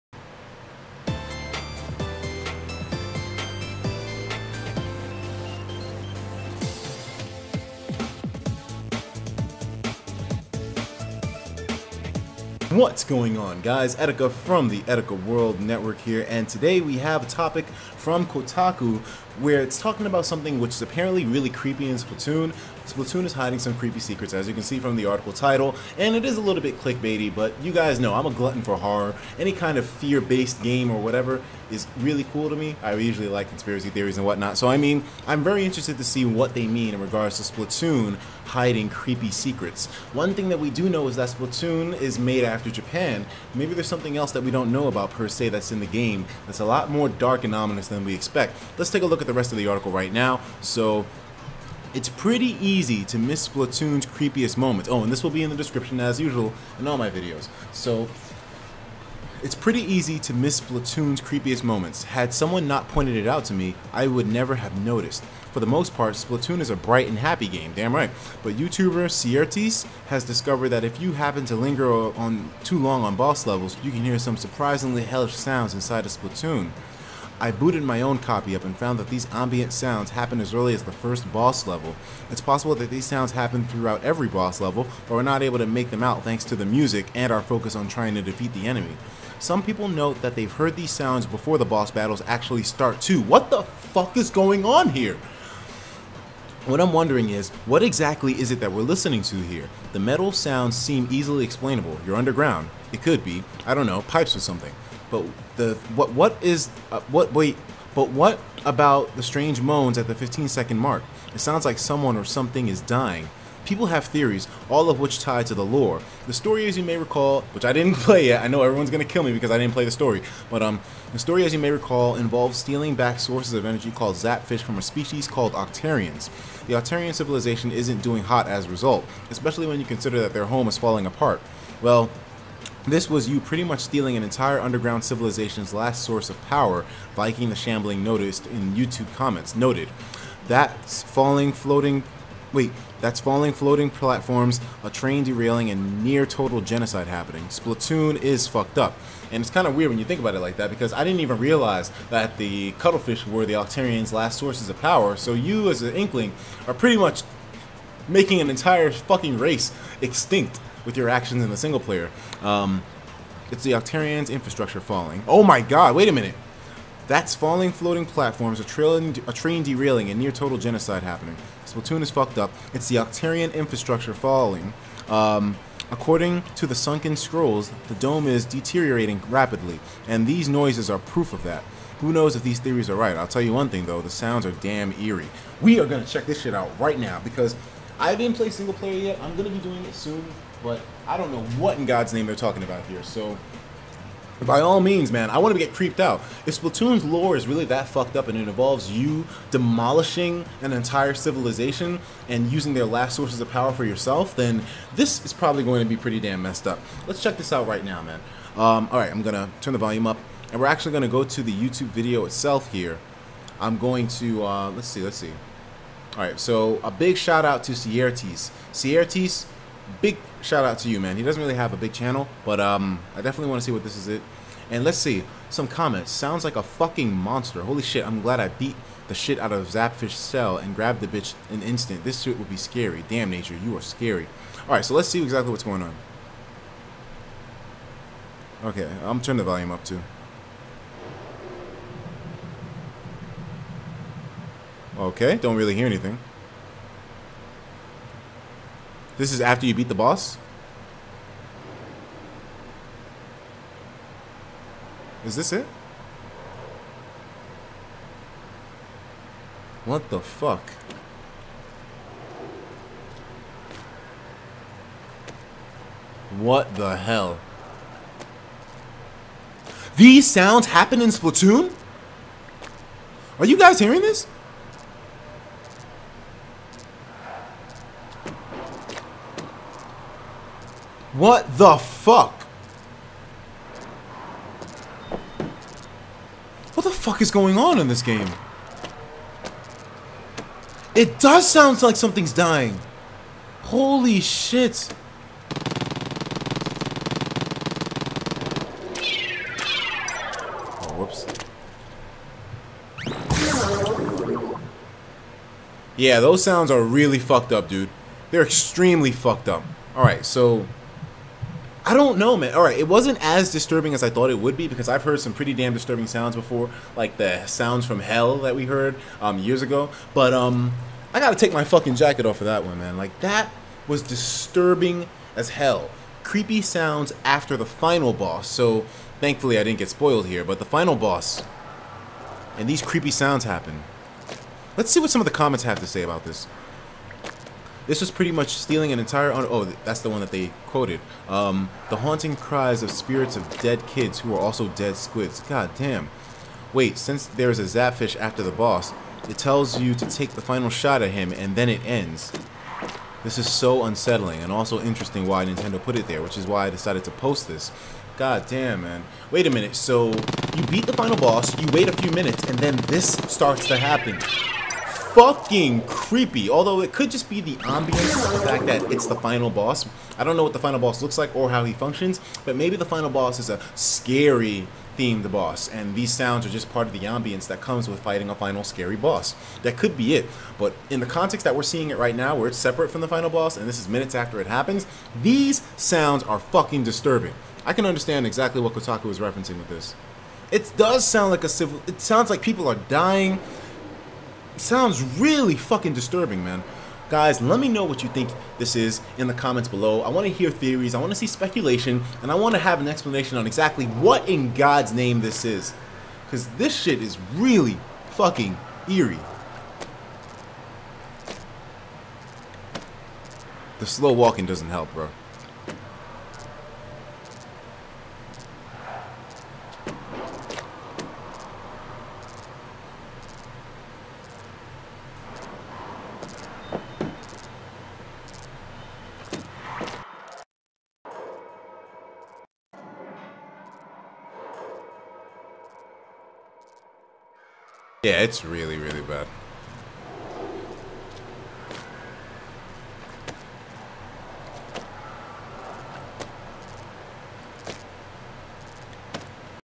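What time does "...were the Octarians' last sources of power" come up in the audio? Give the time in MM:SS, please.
02:33.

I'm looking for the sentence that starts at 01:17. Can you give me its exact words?
I booted my own copy up and found that these ambient sounds happen as early as the first boss level.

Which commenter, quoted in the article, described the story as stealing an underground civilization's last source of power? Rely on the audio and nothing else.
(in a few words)
Viking the Shambling.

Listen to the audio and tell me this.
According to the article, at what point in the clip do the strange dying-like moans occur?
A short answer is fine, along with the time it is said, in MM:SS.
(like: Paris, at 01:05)
15 seconds, at 01:50.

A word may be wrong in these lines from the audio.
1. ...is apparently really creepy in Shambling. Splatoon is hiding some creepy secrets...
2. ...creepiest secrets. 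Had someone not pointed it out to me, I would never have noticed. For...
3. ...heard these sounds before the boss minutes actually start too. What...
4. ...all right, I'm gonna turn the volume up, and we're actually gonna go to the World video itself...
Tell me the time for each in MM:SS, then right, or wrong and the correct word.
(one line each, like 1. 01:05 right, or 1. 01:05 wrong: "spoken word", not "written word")
1. 00:20 wrong: "Splatoon", not "Shambling"
2. 01:01 wrong: "moments", not "secrets"
3. 01:30 wrong: "battles", not "minutes"
4. 03:28 wrong: "YouTube", not "World".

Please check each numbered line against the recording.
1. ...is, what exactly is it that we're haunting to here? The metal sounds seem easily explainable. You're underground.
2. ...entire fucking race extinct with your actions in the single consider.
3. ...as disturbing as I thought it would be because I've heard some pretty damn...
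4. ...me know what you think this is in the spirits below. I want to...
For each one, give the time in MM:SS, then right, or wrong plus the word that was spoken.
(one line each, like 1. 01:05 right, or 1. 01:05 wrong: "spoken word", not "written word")
1. 01:37 wrong: "listening", not "haunting"
2. 02:38 wrong: "player", not "consider"
3. 05:13 right
4. 06:37 wrong: "comments", not "spirits".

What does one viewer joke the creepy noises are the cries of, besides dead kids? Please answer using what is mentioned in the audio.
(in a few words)
squids.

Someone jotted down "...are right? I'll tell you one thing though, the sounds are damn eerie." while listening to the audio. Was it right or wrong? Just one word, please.
right.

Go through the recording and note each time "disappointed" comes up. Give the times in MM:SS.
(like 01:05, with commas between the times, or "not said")
not said.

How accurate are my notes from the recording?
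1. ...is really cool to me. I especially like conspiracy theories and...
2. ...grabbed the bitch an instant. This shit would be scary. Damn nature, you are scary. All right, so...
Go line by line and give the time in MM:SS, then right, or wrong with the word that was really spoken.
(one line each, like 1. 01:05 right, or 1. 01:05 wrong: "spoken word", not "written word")
1. 00:31 wrong: "usually", not "especially"
2. 03:50 right.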